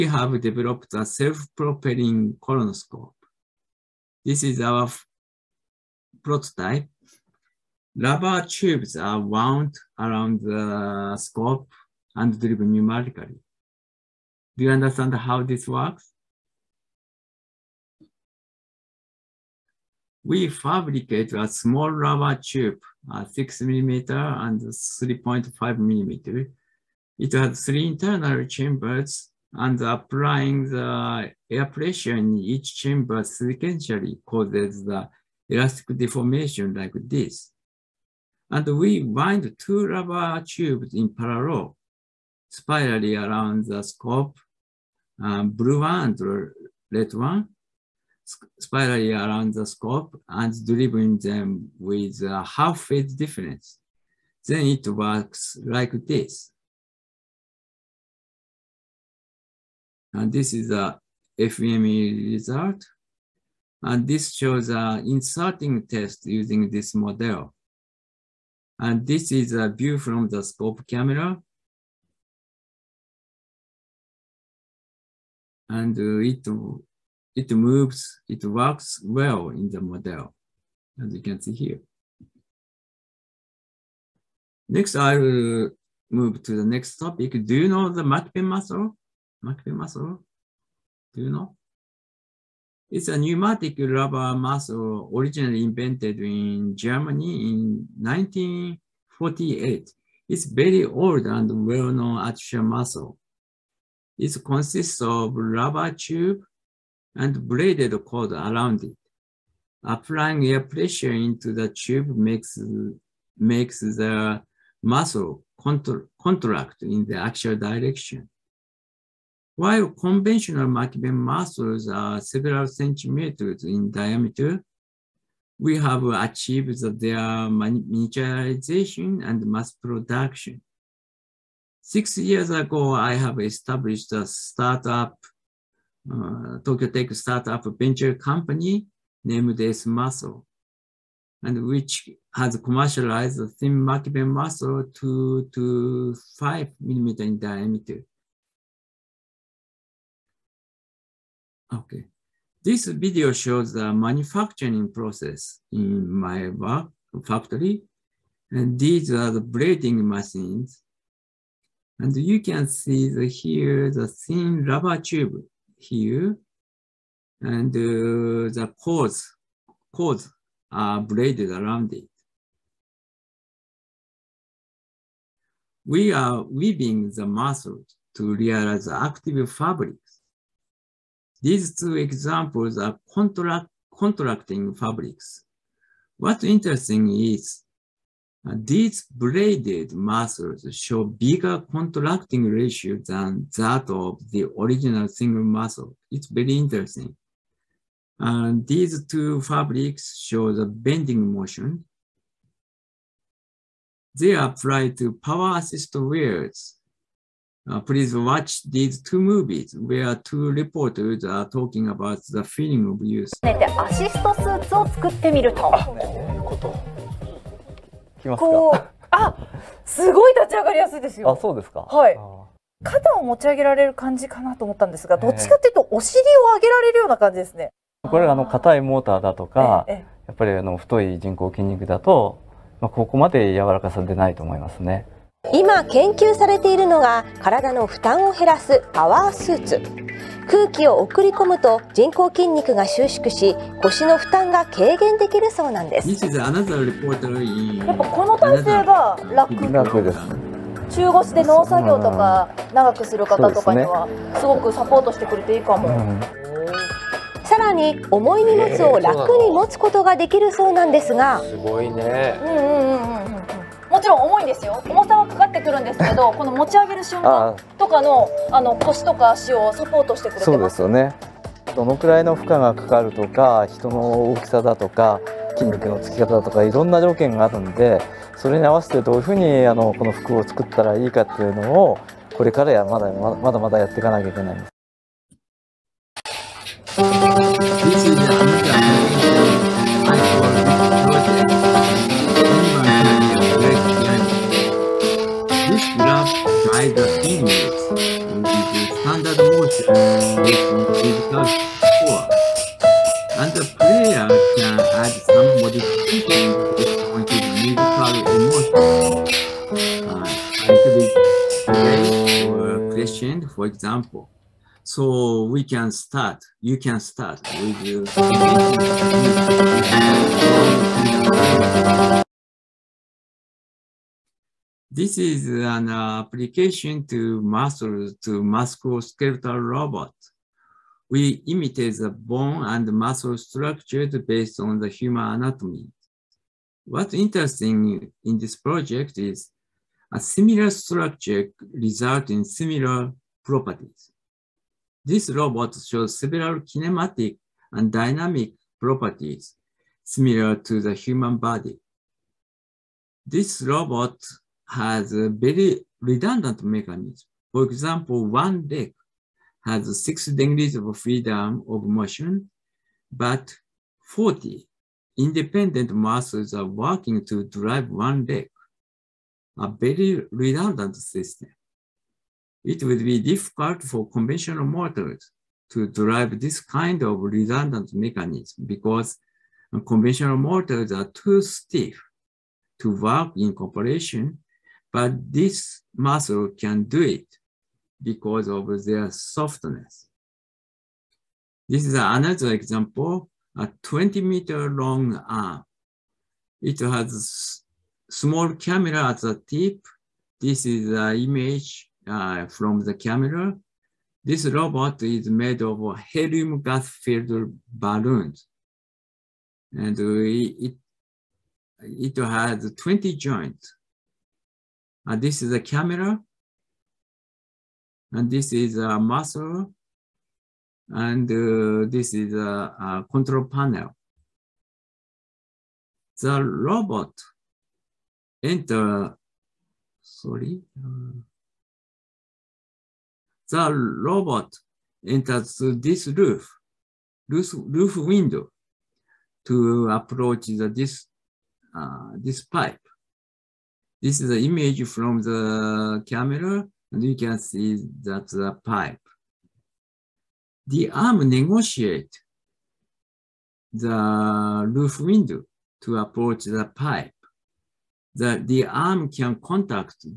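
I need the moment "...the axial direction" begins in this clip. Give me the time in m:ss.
1:57.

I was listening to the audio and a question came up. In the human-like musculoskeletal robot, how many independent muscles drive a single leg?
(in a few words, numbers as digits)
40.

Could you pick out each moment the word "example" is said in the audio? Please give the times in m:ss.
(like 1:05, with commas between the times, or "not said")
3:01, 5:13, 5:57, 6:32.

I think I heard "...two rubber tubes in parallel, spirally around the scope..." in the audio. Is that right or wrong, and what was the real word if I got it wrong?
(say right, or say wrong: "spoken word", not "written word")
right.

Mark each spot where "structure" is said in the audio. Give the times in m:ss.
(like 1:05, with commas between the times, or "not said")
5:33, 5:40.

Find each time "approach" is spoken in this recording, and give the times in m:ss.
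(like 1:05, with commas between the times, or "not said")
7:19, 7:35.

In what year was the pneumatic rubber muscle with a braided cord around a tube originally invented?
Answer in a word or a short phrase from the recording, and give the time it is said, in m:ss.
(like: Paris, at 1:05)
1948, at 1:38.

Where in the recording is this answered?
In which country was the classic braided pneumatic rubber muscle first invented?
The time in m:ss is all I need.
1:36.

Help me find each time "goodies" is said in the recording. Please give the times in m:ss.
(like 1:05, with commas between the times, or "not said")
not said.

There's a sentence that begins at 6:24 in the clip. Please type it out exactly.
but this muscle can do it because of their softness.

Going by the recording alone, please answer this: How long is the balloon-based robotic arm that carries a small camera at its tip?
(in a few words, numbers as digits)
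20 meters.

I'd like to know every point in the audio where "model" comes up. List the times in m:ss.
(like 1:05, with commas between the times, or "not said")
1:06, 1:19.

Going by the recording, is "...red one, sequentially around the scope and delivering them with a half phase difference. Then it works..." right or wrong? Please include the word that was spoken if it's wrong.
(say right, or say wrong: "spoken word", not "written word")
wrong: "spirally", not "sequentially".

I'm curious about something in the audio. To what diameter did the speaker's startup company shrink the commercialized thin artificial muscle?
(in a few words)
5 millimeters.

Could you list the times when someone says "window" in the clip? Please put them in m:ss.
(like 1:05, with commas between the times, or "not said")
7:17, 7:34.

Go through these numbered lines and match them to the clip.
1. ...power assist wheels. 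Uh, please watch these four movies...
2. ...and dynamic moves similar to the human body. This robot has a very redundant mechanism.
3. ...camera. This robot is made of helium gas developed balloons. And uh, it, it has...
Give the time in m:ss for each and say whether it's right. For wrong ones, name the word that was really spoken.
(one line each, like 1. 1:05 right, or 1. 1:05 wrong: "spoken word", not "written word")
1. 3:25 wrong: "two", not "four"
2. 5:47 wrong: "properties", not "moves"
3. 6:42 wrong: "filled", not "developed".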